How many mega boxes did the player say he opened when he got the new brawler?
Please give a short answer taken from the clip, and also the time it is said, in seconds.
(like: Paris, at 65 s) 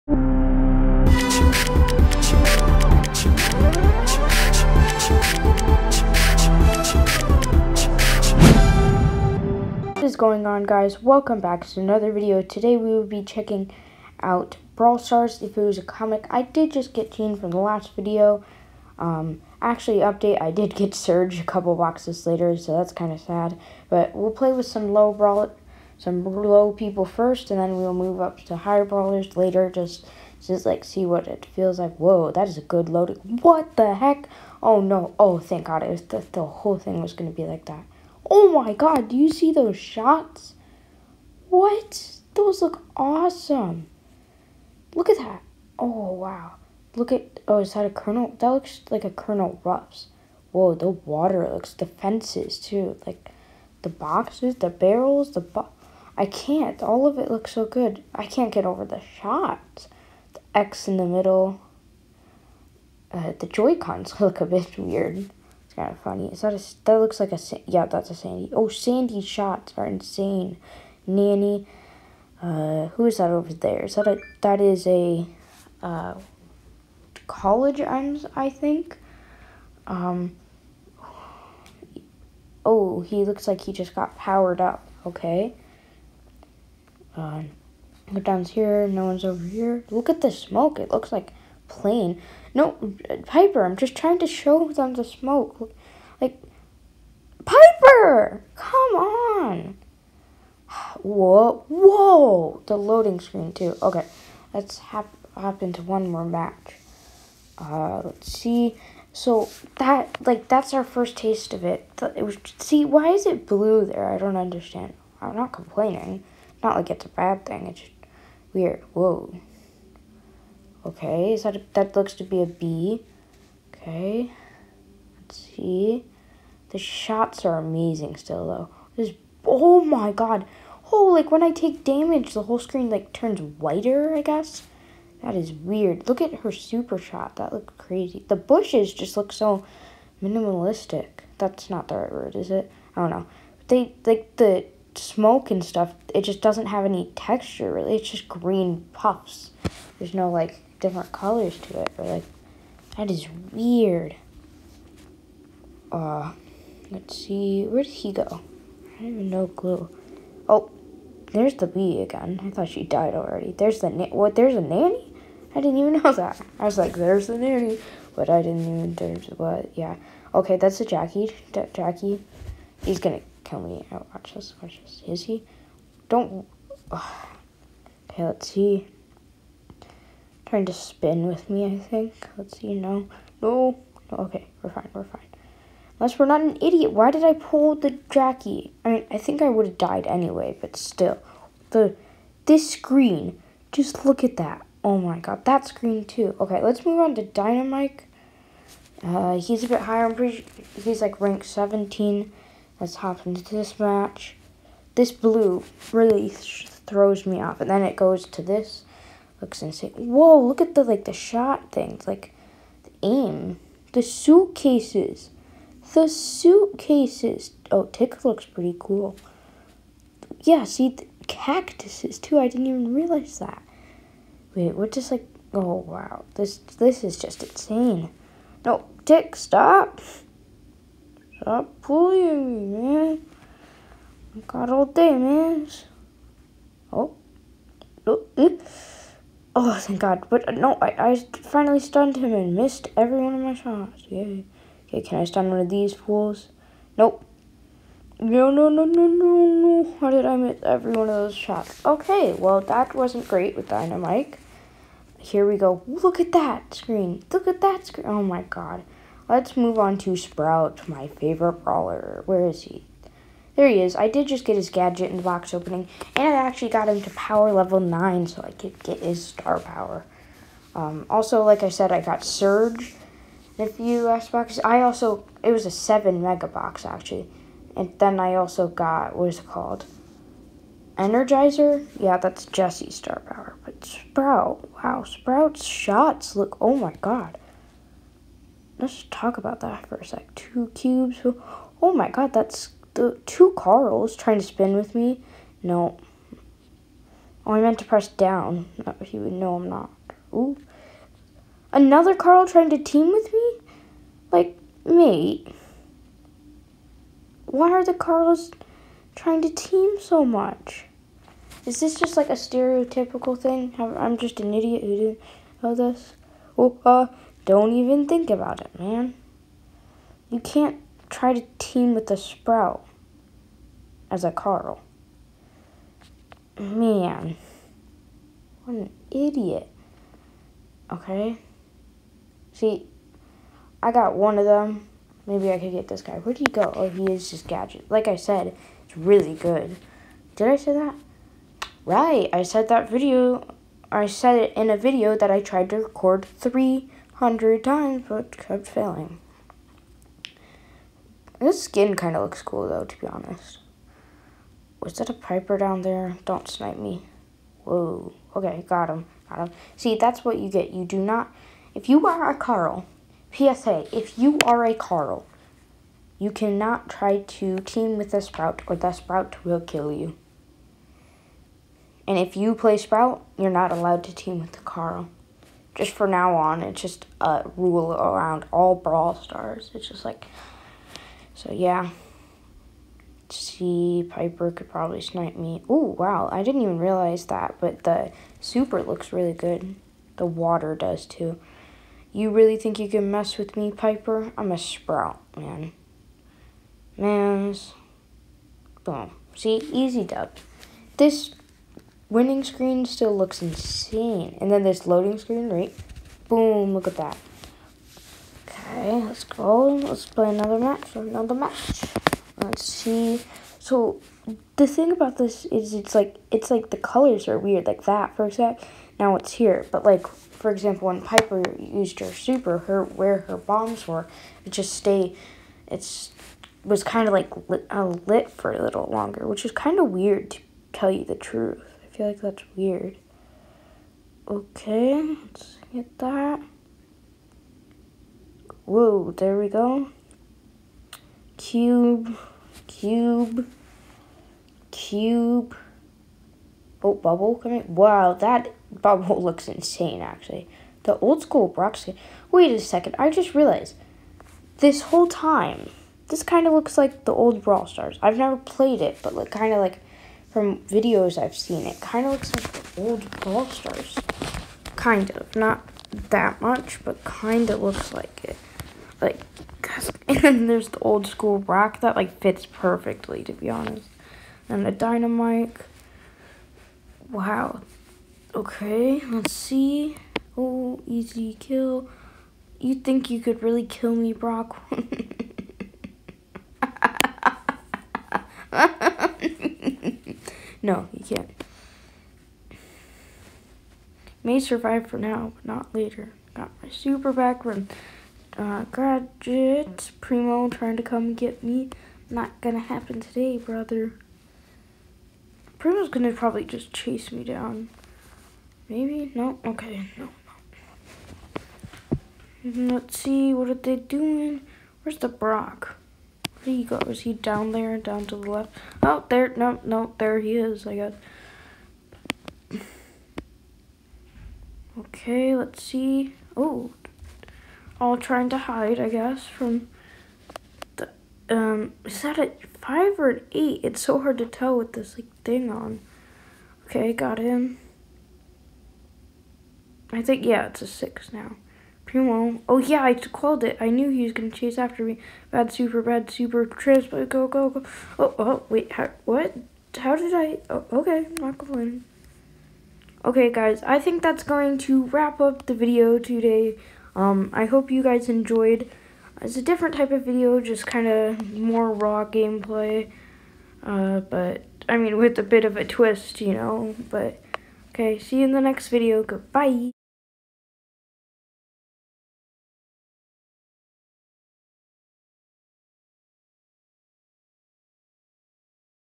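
7, at 275 s.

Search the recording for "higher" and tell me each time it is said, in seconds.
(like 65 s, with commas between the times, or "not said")
28 s, 199 s.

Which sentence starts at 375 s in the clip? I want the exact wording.
Just for now on, it's just a rule around all Brawl Stars.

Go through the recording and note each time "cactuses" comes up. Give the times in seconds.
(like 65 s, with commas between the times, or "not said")
221 s.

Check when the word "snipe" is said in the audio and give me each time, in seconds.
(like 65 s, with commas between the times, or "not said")
356 s, 385 s.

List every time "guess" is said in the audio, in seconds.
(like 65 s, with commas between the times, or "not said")
134 s, 520 s, 528 s.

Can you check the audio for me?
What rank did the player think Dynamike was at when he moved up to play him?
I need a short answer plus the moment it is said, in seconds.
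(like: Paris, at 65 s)
17, at 201 s.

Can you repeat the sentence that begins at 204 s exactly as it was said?
This blue really th throws me off.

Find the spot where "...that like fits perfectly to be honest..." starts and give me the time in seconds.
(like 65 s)
471 s.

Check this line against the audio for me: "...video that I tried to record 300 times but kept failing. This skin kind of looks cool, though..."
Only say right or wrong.
right.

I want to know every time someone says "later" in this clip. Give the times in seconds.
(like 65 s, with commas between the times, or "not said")
22 s, 29 s, 495 s.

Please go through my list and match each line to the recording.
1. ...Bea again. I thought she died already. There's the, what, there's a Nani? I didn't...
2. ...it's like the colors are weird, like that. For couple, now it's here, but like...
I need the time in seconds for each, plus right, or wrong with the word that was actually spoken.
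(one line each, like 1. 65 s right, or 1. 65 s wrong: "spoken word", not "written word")
1. 161 s right
2. 416 s wrong: "example", not "couple".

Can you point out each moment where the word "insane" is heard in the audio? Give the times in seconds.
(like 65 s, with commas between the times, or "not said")
69 s, 209 s, 227 s, 403 s, 449 s.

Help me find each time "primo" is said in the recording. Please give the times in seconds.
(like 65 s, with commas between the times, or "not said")
499 s, 505 s, 541 s.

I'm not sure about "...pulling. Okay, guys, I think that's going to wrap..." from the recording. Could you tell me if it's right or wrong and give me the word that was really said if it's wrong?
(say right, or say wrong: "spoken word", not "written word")
wrong: "complaining", not "pulling".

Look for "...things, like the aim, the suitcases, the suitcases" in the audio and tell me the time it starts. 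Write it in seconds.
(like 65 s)
211 s.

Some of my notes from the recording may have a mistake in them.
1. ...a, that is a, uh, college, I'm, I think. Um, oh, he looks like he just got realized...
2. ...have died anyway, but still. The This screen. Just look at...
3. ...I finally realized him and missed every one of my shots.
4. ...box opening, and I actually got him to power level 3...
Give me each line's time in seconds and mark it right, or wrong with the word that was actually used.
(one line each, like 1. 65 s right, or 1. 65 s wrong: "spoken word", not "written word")
1. 74 s wrong: "powered", not "realized"
2. 189 s right
3. 241 s wrong: "stunned", not "realized"
4. 265 s wrong: "9", not "3".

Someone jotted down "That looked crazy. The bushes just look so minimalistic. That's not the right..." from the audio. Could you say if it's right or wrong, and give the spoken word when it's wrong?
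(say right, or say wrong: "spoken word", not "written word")
right.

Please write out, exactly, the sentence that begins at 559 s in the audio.
It's a different type of video, just kind of more raw gameplay.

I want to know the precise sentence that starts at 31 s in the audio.
Whoa, that is a good loading.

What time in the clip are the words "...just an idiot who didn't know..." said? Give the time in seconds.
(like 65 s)
314 s.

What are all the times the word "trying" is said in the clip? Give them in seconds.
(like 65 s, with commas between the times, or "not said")
93 s, 180 s, 294 s, 302 s, 309 s, 500 s, 527 s.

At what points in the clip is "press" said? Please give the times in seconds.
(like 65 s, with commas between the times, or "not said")
297 s.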